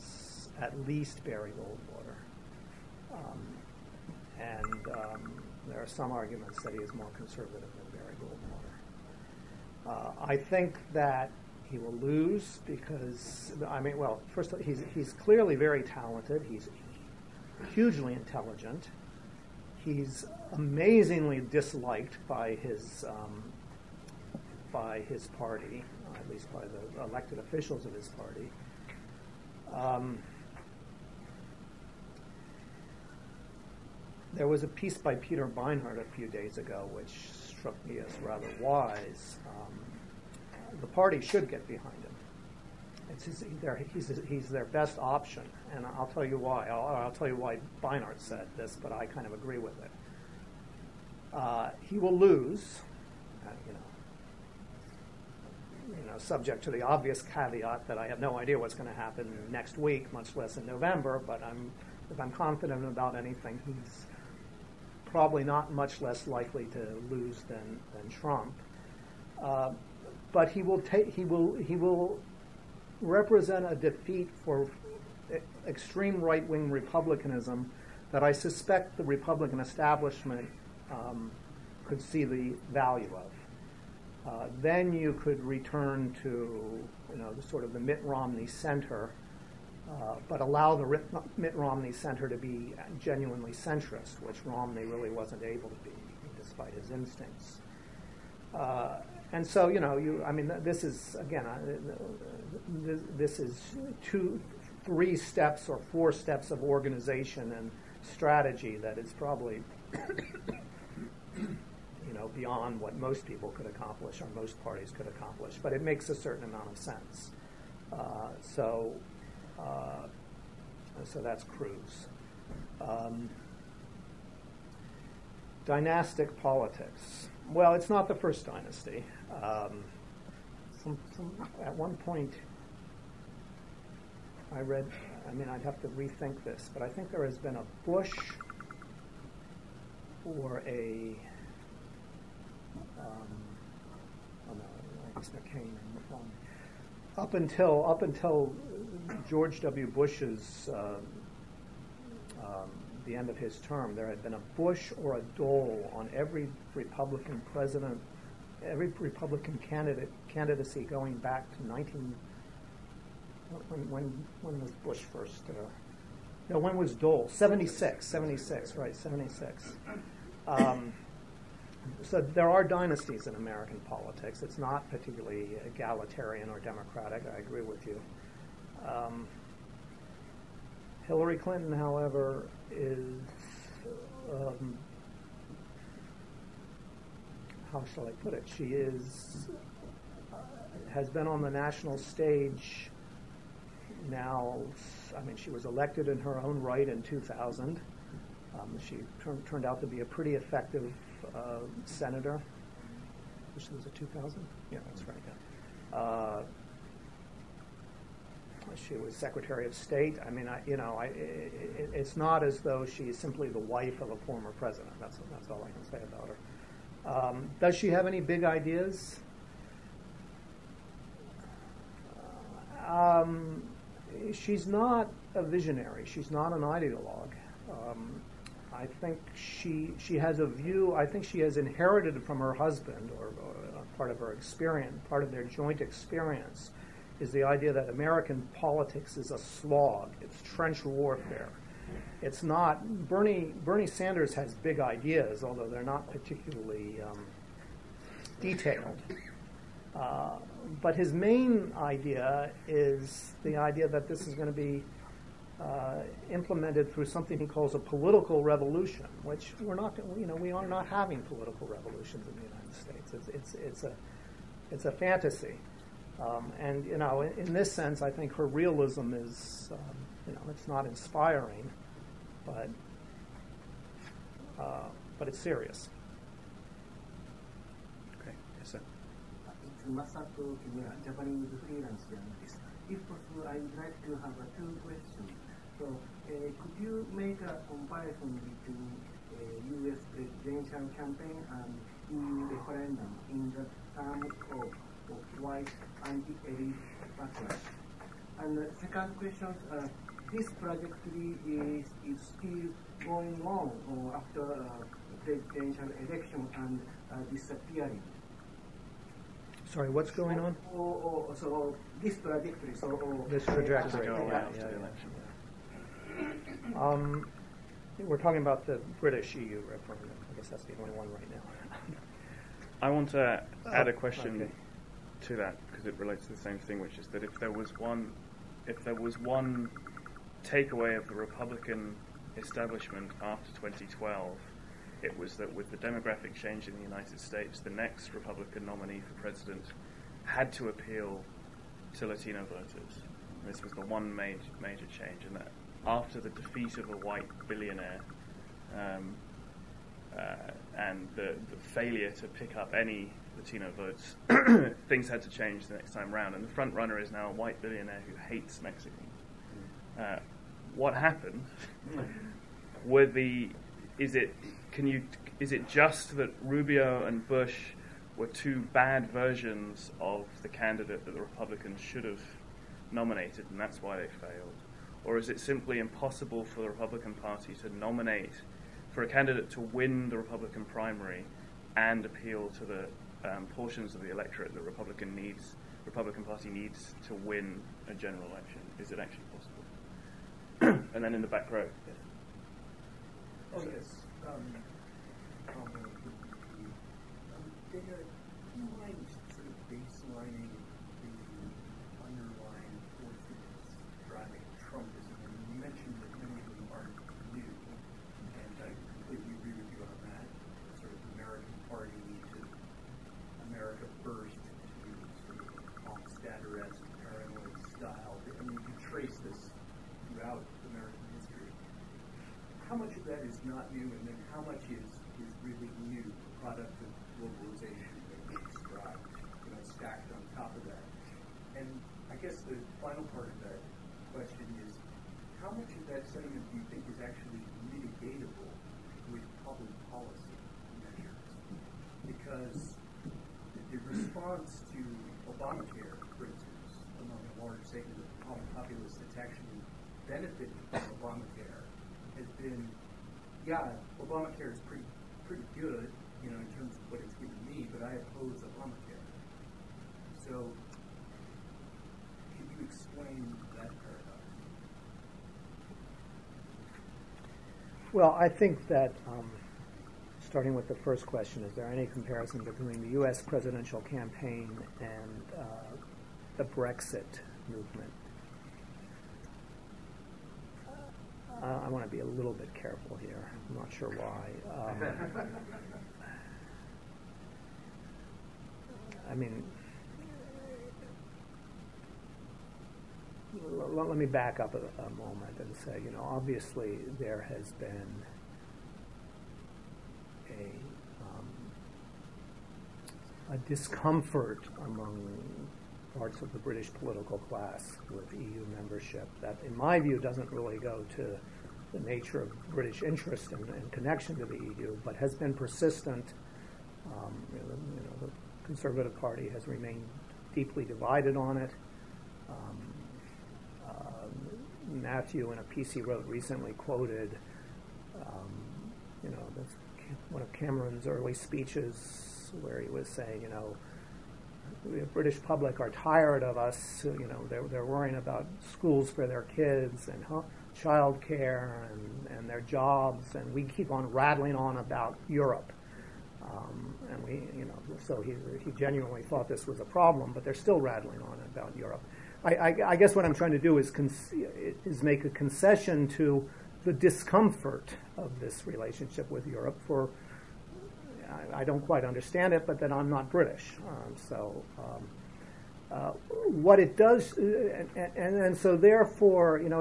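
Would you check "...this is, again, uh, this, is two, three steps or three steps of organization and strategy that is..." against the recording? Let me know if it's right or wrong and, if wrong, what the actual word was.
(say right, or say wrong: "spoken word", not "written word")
wrong: "four", not "three".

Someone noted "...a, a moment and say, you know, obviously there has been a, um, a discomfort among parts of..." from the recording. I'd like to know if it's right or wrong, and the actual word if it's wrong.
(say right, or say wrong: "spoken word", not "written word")
right.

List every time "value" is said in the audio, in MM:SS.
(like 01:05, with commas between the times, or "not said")
01:22.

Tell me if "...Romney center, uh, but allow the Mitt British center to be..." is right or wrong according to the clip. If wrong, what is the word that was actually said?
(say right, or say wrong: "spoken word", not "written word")
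wrong: "Romney", not "British".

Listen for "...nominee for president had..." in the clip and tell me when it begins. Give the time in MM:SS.
05:38.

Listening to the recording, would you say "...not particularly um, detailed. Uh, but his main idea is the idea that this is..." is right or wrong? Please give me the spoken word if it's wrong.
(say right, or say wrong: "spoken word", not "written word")
right.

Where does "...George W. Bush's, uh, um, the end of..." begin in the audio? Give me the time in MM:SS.
02:29.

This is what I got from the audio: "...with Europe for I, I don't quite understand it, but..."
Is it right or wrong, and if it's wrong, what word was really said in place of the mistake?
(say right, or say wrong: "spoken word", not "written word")
right.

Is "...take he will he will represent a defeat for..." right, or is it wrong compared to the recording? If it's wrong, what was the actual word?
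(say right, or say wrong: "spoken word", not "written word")
right.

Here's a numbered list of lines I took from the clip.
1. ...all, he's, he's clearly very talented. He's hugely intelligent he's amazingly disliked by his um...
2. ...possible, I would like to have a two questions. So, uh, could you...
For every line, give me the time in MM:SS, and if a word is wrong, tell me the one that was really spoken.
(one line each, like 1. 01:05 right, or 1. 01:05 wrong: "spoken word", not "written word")
1. 00:14 right
2. 04:43 right.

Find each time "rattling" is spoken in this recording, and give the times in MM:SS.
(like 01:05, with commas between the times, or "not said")
09:03, 09:10.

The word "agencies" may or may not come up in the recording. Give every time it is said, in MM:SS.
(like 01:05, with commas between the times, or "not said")
not said.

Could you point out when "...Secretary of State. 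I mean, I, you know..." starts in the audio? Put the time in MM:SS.
03:29.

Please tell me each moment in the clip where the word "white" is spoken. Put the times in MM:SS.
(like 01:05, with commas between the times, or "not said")
04:55, 05:46, 05:57.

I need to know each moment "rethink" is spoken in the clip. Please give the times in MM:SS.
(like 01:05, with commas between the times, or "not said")
02:15.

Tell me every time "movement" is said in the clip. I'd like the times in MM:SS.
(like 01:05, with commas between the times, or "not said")
07:57.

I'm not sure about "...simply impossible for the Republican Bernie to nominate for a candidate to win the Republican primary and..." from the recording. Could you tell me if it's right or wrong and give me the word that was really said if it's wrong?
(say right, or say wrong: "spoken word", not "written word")
wrong: "Party", not "Bernie".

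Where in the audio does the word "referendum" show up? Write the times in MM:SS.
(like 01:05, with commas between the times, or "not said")
04:52, 05:19.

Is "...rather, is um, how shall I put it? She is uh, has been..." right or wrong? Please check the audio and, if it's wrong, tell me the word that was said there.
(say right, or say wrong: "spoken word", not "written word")
wrong: "however", not "rather".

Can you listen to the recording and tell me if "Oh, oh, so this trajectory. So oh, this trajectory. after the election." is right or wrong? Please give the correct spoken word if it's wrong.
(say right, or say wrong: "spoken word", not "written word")
right.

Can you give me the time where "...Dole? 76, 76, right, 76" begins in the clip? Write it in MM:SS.
02:46.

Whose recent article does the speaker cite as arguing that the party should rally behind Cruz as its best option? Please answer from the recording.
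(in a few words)
Peter Beinart.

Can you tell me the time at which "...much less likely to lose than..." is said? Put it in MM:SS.
01:05.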